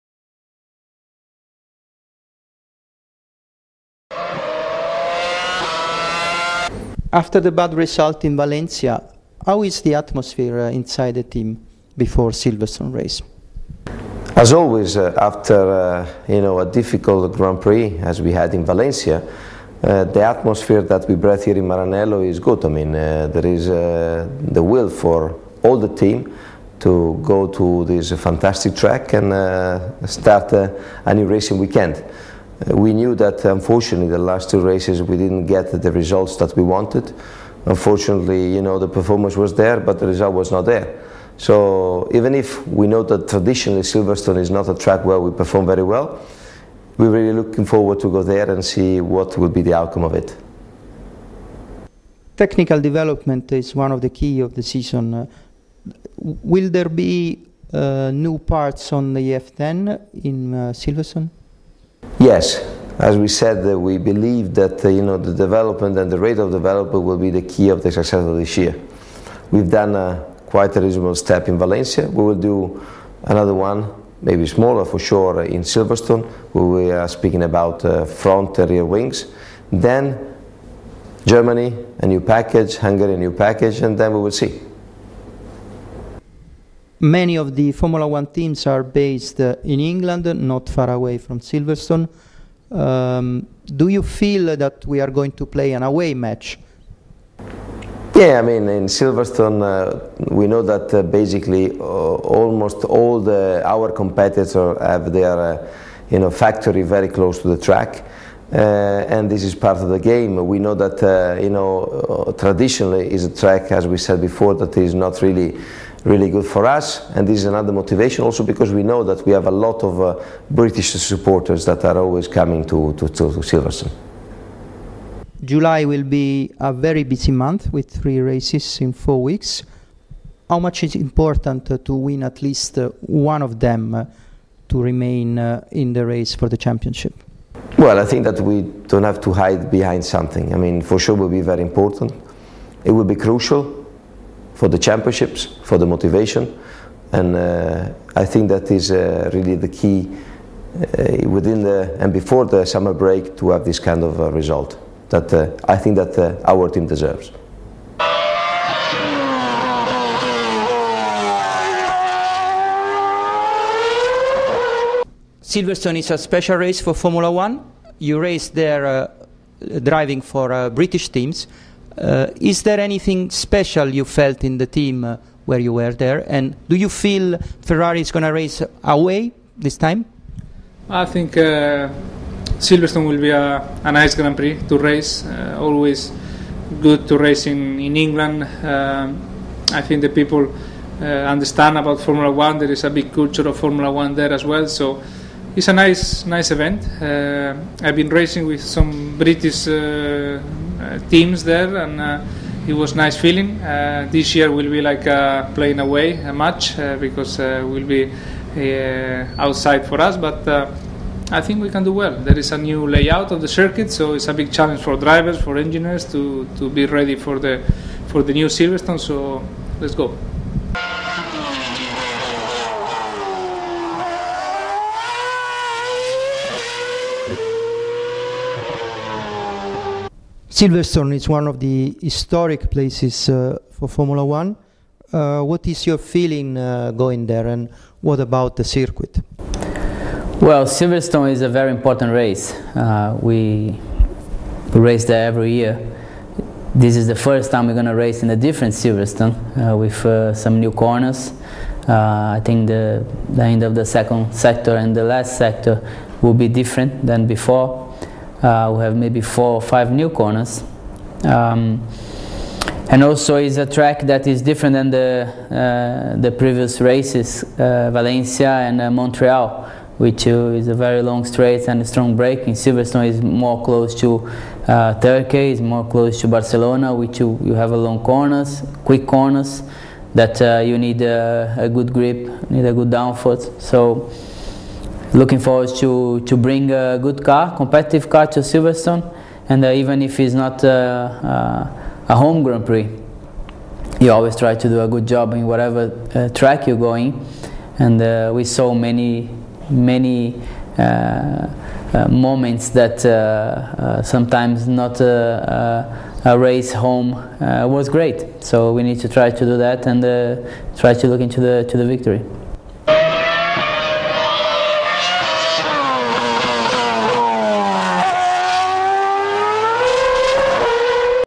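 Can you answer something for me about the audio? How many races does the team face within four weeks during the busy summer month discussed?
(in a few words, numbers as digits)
3.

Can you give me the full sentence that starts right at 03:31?
I think we can do well.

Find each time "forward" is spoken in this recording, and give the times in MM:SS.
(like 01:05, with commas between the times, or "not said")
00:47, 04:45.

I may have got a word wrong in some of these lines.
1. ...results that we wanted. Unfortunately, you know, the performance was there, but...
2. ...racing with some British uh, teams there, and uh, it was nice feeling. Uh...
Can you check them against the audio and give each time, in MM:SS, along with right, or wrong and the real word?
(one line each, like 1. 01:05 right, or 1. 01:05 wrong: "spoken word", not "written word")
1. 00:35 right
2. 03:18 right.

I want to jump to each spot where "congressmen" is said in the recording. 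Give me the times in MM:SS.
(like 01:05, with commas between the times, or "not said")
not said.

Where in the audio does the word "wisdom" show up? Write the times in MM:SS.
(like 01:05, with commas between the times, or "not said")
not said.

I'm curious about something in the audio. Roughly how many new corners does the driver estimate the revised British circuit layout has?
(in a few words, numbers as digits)
four or five.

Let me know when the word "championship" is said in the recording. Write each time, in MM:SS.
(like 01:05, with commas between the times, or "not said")
02:16, 02:24.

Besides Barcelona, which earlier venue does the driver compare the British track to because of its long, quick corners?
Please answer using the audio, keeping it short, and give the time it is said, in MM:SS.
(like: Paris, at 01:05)
Turkey, at 04:34.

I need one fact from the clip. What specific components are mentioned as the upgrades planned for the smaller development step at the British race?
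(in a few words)
front and rear wings.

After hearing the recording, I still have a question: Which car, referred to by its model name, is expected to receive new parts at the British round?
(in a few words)
F10.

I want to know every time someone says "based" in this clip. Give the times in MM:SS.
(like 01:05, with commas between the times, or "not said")
01:28.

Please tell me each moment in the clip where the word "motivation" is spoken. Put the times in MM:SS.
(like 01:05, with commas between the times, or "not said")
01:57, 02:25.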